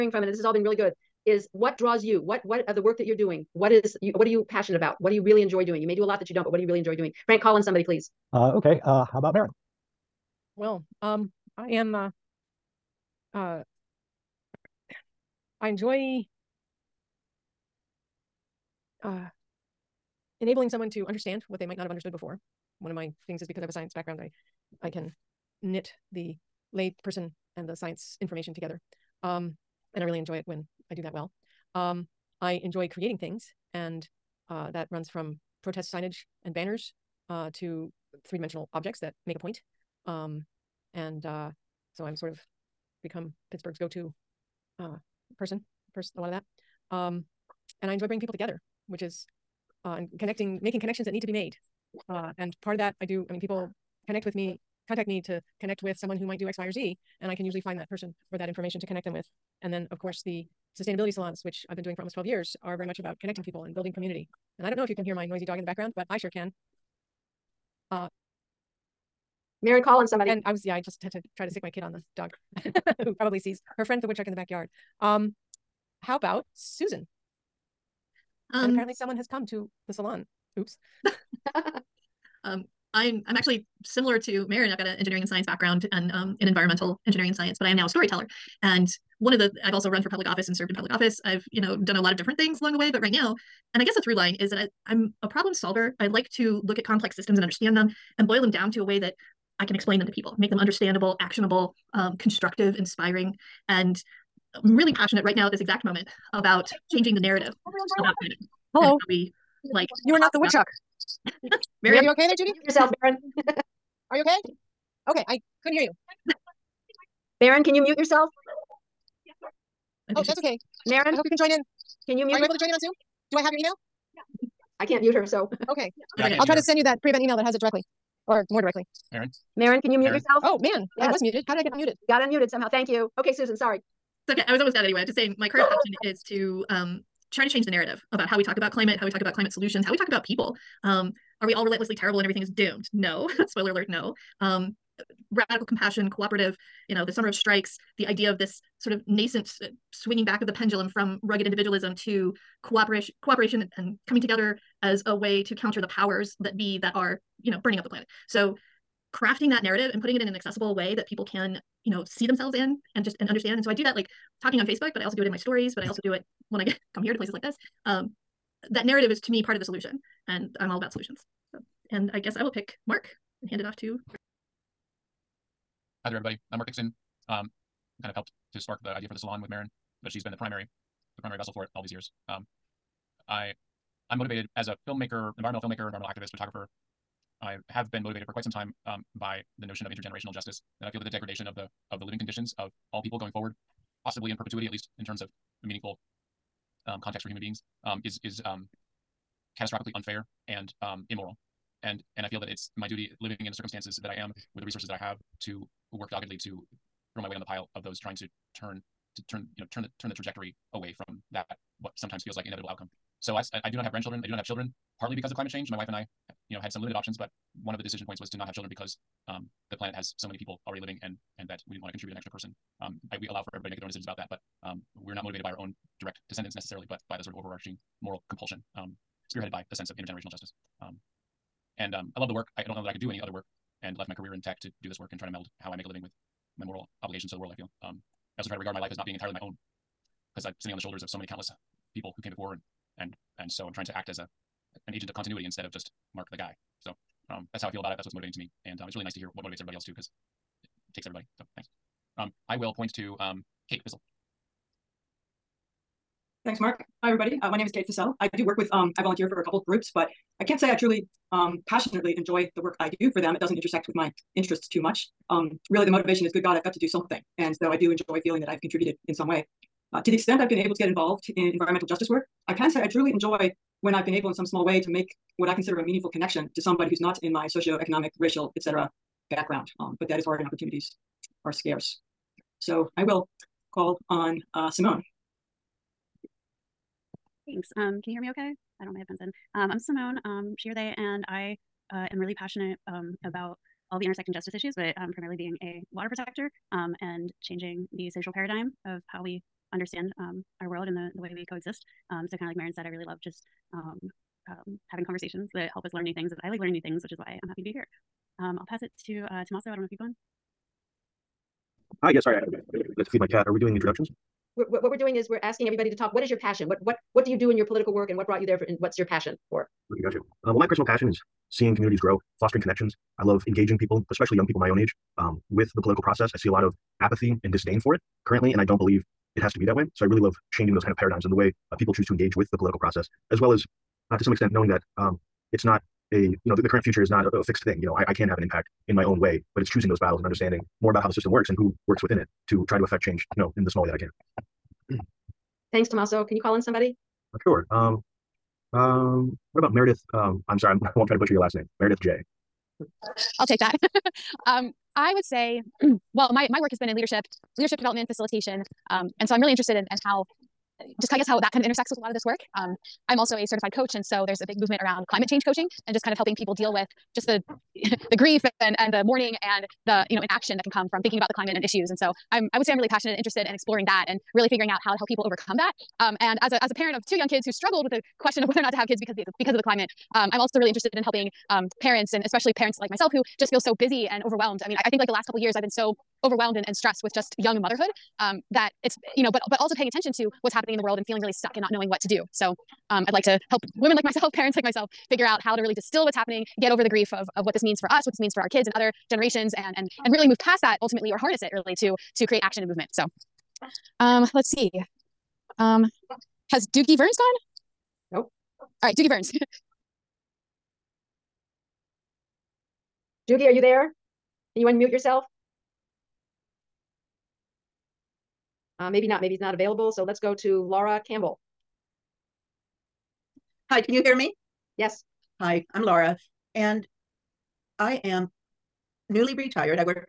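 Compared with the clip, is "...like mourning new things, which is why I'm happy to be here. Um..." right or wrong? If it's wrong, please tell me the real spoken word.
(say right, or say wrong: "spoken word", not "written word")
wrong: "learning", not "mourning".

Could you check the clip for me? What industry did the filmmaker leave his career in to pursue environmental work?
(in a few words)
tech.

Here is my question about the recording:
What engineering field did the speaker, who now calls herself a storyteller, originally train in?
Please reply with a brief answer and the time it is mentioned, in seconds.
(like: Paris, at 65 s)
environmental engineering, at 86 s.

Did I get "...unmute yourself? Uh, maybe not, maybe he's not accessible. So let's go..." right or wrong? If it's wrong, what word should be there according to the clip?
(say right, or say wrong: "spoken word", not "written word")
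wrong: "available", not "accessible".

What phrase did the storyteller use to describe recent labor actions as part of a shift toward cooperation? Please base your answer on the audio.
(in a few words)
summer of strikes.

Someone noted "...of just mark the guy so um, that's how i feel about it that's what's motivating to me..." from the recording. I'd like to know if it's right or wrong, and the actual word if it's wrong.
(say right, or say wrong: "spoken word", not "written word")
right.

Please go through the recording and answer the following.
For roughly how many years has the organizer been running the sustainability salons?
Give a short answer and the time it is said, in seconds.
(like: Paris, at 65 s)
12 years, at 62 s.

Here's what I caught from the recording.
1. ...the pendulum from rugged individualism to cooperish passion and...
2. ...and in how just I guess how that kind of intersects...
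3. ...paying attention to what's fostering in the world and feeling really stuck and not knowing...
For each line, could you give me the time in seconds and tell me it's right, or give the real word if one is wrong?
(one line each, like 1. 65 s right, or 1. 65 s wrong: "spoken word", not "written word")
1. 150 s wrong: "cooperation", not "passion"
2. 359 s right
3. 389 s wrong: "happening", not "fostering".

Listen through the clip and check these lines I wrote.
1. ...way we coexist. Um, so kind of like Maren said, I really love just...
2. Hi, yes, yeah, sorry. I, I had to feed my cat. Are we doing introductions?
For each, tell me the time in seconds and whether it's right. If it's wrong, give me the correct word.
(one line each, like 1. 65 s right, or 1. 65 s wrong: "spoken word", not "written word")
1. 301 s right
2. 312 s right.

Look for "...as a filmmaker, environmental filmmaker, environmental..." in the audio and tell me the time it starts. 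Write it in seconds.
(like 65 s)
184 s.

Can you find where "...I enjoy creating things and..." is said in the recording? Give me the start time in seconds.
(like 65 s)
32 s.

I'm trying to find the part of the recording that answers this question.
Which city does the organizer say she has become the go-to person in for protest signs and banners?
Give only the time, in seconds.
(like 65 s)
43 s.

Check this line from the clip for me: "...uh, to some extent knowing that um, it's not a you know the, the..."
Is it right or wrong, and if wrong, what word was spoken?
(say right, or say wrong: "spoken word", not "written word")
right.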